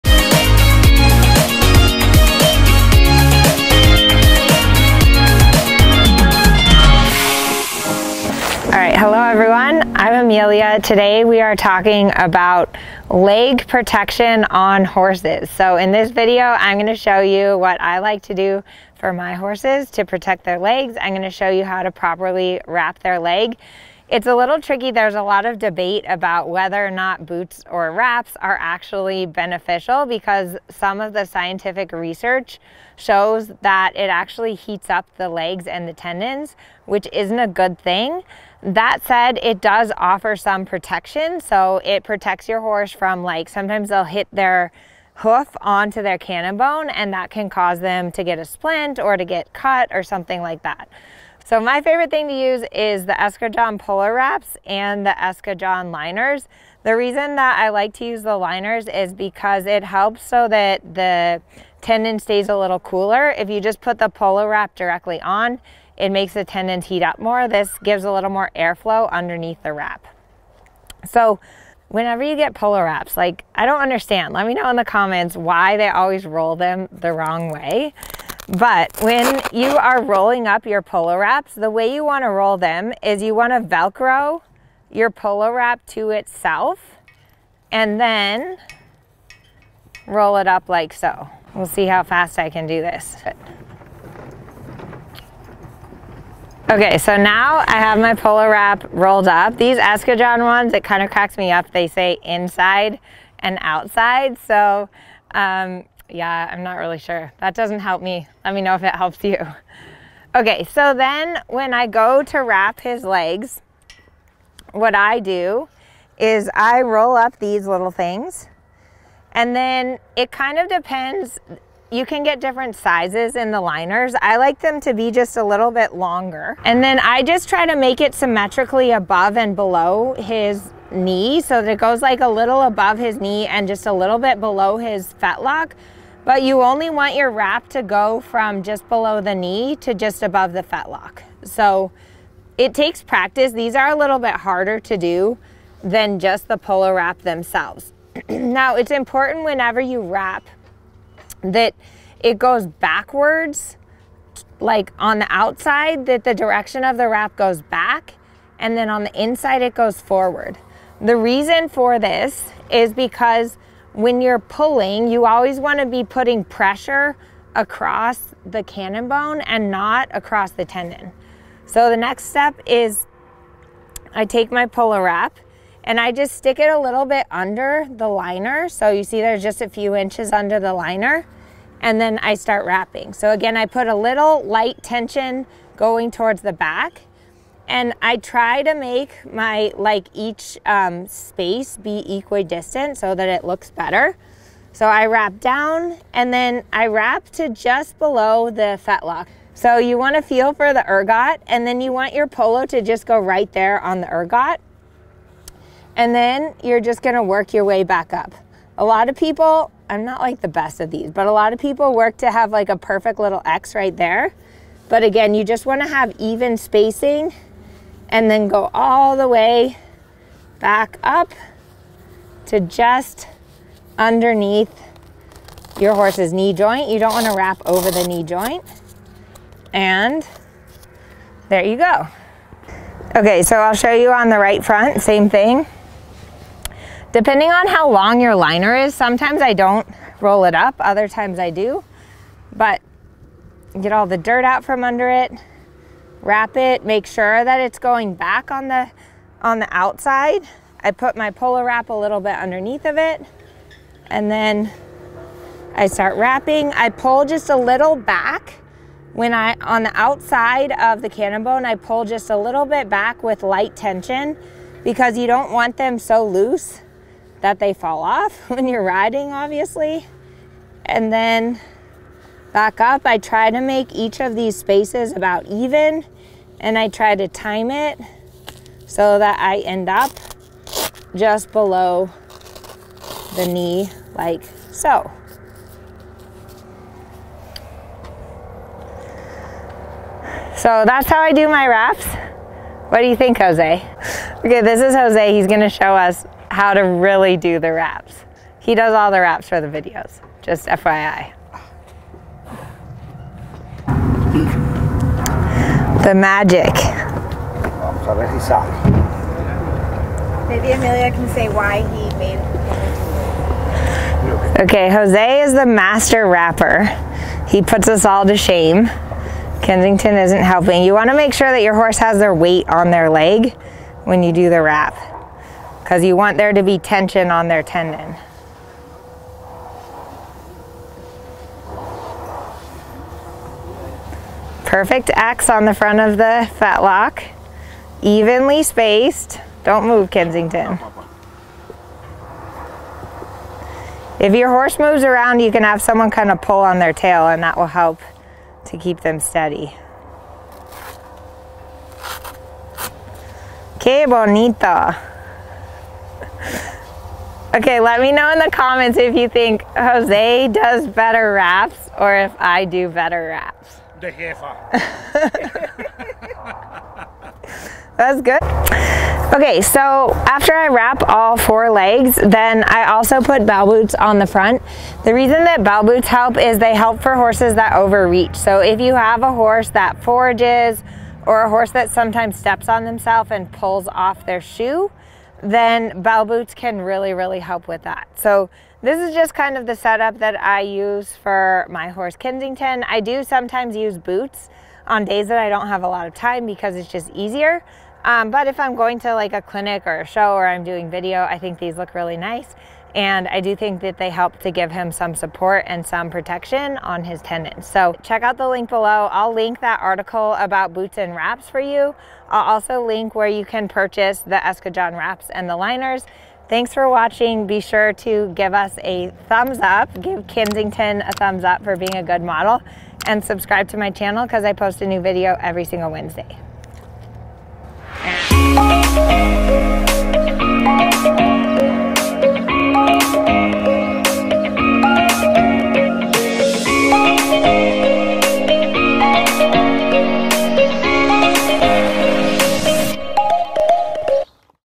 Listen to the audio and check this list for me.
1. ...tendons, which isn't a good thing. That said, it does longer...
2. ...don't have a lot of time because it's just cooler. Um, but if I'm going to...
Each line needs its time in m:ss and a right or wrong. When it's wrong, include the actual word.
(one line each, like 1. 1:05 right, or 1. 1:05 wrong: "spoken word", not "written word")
1. 0:35 wrong: "offer", not "longer"
2. 6:35 wrong: "easier", not "cooler".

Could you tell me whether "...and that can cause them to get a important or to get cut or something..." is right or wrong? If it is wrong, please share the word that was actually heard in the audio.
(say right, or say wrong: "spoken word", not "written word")
wrong: "splint", not "important".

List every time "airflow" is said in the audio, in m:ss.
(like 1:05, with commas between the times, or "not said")
1:08.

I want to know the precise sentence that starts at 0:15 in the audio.
So in this video, I'm gonna show you what I like to do for my horses to protect their legs.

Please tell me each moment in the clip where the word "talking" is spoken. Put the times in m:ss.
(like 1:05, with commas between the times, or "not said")
0:11.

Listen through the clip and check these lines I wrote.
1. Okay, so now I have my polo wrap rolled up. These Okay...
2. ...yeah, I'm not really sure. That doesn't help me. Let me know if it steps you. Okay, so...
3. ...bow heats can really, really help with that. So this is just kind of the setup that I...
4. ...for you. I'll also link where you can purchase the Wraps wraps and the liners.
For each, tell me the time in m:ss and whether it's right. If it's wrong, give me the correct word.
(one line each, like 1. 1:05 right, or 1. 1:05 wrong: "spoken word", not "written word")
1. 1:36 wrong: "Eskadron", not "Okay"
2. 1:46 wrong: "helps", not "steps"
3. 6:26 wrong: "boots", not "heats"
4. 6:51 wrong: "Eskadron", not "Wraps".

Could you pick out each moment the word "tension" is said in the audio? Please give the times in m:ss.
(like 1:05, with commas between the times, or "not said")
3:04, 4:23, 5:26.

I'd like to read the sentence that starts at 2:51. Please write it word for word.
So the next step is I take my polo wrap and I just stick it a little bit under the liner.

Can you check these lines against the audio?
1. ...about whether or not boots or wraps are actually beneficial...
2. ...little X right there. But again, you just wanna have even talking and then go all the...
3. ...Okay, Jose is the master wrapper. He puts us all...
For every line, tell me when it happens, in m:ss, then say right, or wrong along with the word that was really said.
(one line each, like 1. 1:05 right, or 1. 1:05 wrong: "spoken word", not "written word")
1. 0:26 right
2. 3:33 wrong: "spacing", not "talking"
3. 5:14 right.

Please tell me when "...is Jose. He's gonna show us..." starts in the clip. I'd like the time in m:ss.
4:54.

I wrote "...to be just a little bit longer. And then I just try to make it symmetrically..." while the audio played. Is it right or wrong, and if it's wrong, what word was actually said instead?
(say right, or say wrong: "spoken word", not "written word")
right.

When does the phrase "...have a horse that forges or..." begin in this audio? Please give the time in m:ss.
6:18.